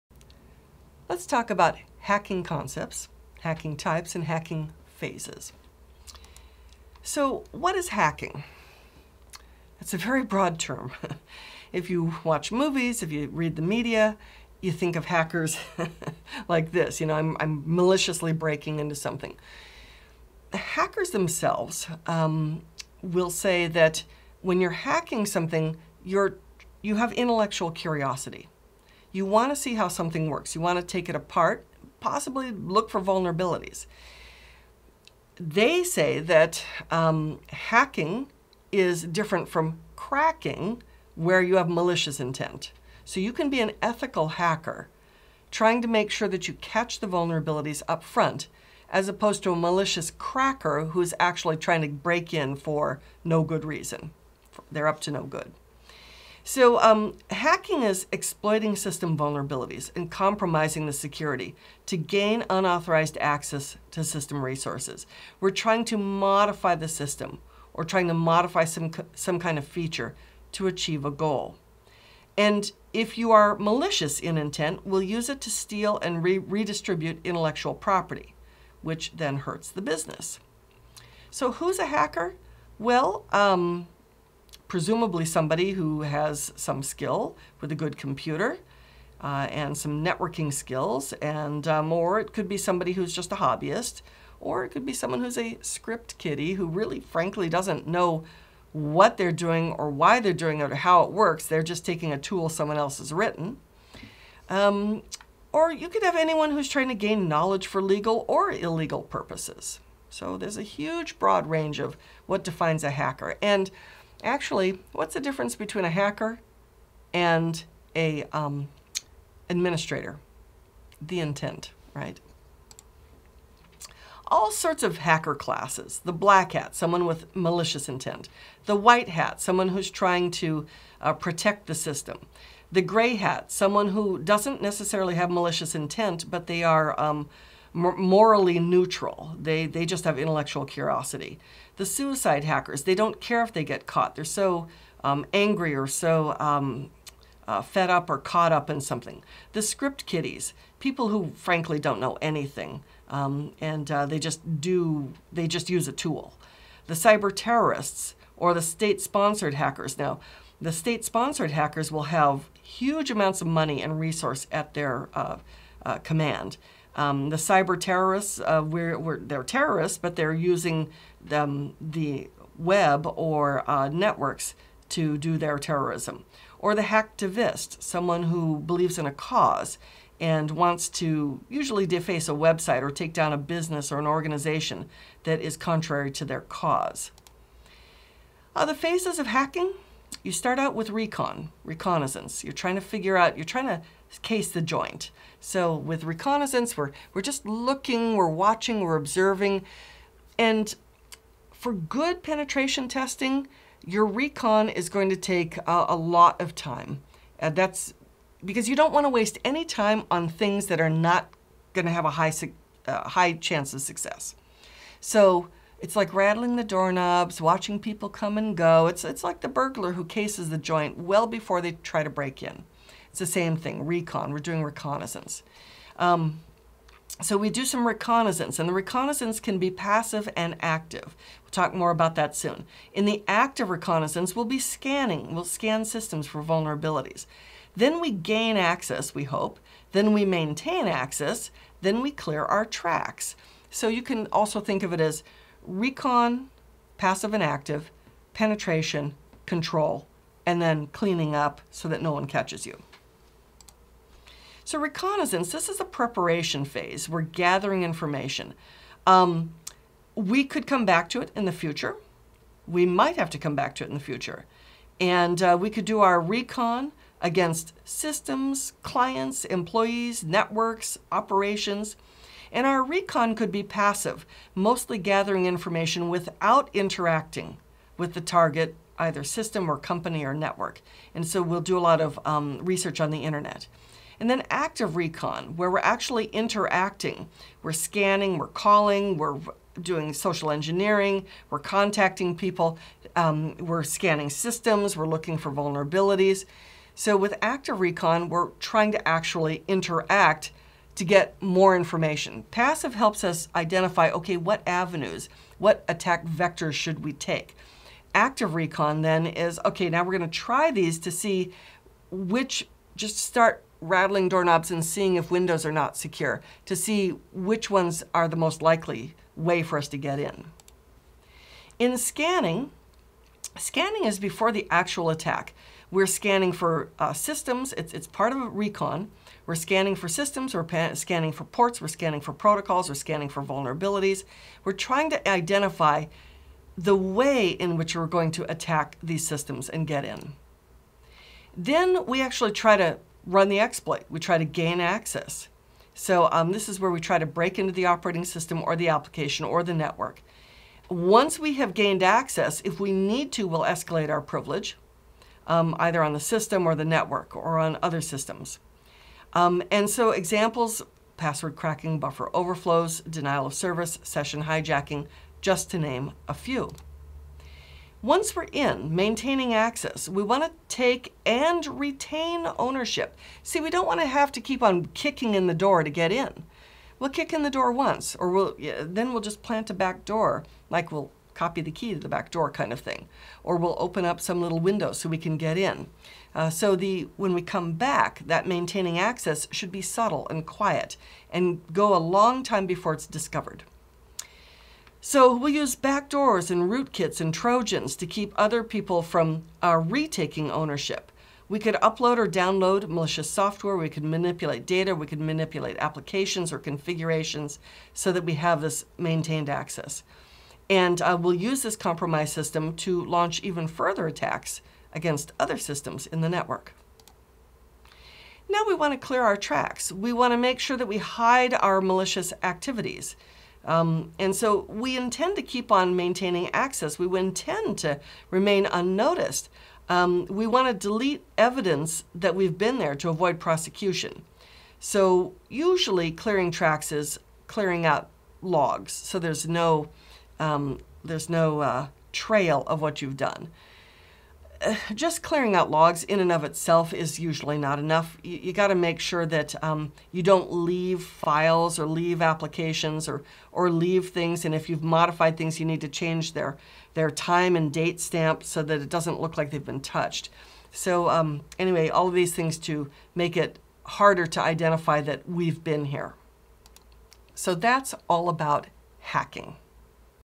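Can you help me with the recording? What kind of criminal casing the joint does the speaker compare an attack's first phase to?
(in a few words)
Burglar.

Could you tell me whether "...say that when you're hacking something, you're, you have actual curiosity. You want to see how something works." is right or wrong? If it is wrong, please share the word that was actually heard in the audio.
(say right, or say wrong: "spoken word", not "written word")
wrong: "intellectual", not "actual".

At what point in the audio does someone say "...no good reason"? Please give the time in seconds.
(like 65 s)
53 s.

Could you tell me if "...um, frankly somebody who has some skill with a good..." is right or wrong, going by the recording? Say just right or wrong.
wrong.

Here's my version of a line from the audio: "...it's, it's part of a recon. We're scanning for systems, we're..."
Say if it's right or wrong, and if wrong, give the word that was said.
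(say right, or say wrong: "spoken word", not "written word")
right.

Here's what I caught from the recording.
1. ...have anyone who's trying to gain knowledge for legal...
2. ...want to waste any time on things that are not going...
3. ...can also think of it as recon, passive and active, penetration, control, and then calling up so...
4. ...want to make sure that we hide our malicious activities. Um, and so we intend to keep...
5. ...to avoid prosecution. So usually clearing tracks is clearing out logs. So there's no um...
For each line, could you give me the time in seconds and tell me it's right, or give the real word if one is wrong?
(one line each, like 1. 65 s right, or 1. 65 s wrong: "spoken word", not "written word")
1. 106 s right
2. 208 s right
3. 244 s wrong: "cleaning", not "calling"
4. 420 s right
5. 432 s right.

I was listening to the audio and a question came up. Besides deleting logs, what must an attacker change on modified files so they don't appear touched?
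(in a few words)
Time and date stamp.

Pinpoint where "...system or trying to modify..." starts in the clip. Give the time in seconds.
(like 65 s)
66 s.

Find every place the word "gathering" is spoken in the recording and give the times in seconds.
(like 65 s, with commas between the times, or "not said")
257 s, 274 s.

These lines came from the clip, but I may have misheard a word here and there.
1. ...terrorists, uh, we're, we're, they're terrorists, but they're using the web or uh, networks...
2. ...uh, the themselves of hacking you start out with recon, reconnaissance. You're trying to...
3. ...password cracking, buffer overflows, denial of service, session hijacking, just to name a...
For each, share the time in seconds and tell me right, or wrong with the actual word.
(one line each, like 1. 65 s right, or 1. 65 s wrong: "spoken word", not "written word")
1. 167 s right
2. 188 s wrong: "phases", not "themselves"
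3. 361 s right.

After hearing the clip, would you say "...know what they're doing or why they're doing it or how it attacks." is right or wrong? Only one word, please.
wrong.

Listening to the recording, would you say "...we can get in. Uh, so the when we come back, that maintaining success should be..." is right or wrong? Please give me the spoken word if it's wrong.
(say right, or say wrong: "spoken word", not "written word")
wrong: "access", not "success".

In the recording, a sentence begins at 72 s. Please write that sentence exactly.
And if you are malicious in intent, we'll use it to steal and re redistribute intellectual property, which then hurts the business.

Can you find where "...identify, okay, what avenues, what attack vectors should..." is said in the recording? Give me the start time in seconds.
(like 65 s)
303 s.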